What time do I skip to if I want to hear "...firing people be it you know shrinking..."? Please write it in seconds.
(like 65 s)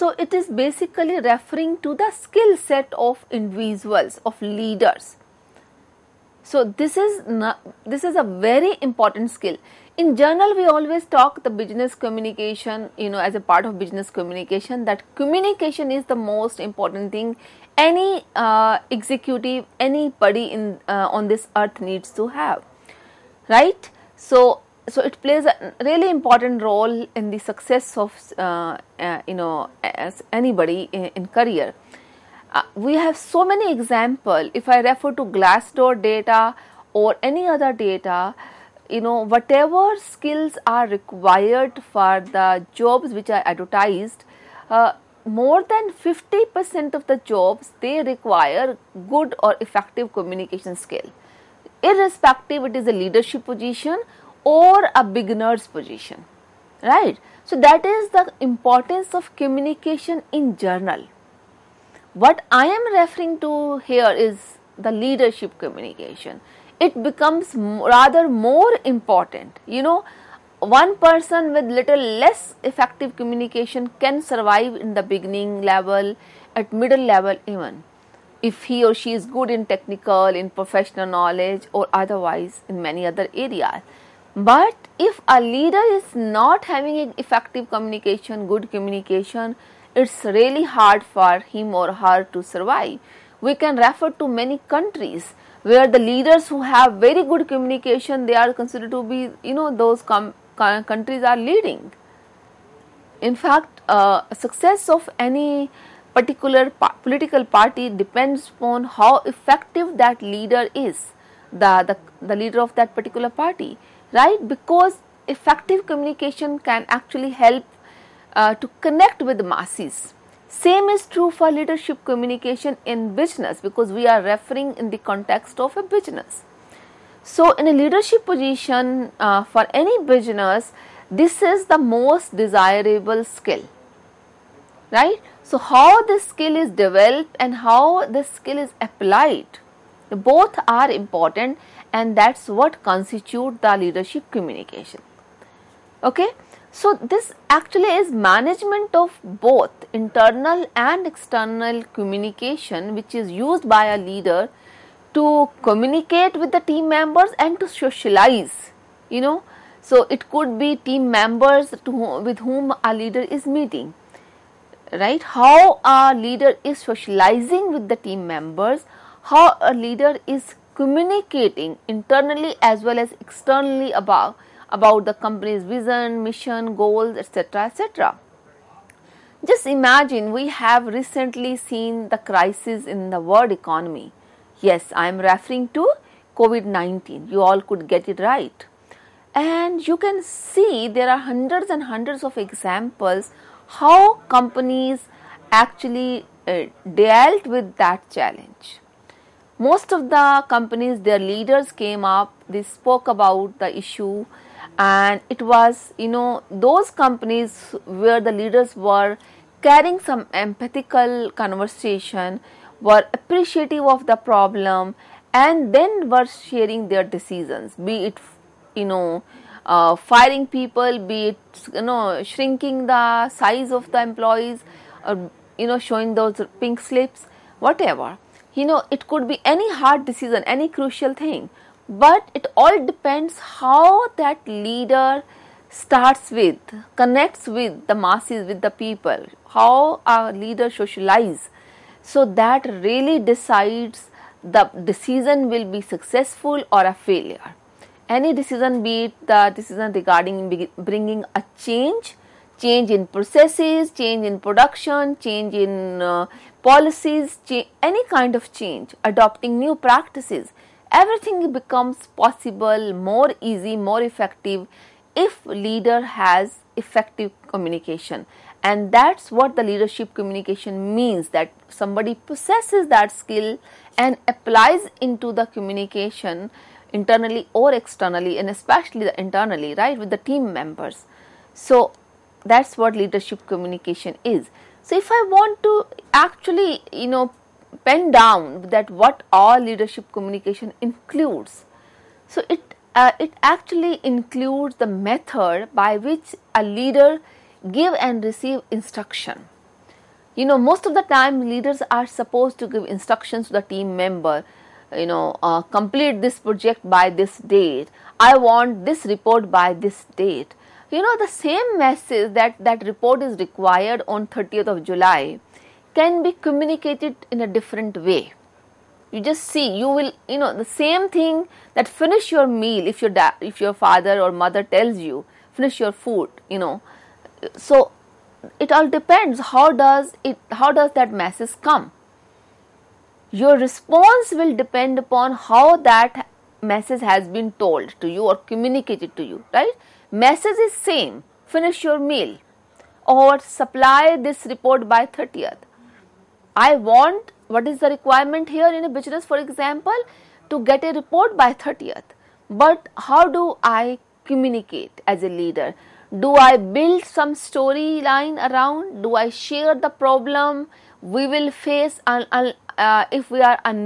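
219 s.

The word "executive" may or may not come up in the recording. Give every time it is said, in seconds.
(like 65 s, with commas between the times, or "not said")
18 s.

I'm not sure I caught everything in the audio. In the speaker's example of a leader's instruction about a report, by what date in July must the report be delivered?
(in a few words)
30th of July.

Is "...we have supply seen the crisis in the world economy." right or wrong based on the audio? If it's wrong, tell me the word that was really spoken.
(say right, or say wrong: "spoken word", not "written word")
wrong: "recently", not "supply".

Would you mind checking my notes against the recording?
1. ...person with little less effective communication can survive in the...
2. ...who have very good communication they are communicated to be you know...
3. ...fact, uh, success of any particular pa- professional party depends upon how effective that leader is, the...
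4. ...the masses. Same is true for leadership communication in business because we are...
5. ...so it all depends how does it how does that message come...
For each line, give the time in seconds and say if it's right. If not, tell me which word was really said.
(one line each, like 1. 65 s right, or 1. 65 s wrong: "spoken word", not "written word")
1. 70 s right
2. 96 s wrong: "considered", not "communicated"
3. 103 s wrong: "political", not "professional"
4. 119 s right
5. 327 s right.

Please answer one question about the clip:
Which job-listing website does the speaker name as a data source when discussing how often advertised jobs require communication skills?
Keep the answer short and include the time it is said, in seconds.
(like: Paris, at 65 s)
Glassdoor, at 35 s.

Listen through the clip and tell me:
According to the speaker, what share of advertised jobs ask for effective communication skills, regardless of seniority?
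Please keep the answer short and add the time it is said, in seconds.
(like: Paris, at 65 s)
more than 50%, at 45 s.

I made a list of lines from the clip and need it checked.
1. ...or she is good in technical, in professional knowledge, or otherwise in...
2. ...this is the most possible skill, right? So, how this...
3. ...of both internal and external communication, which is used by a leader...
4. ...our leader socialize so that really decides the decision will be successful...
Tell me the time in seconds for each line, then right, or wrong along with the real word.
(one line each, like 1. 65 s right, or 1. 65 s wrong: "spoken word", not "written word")
1. 78 s right
2. 131 s wrong: "desirable", not "possible"
3. 148 s right
4. 240 s right.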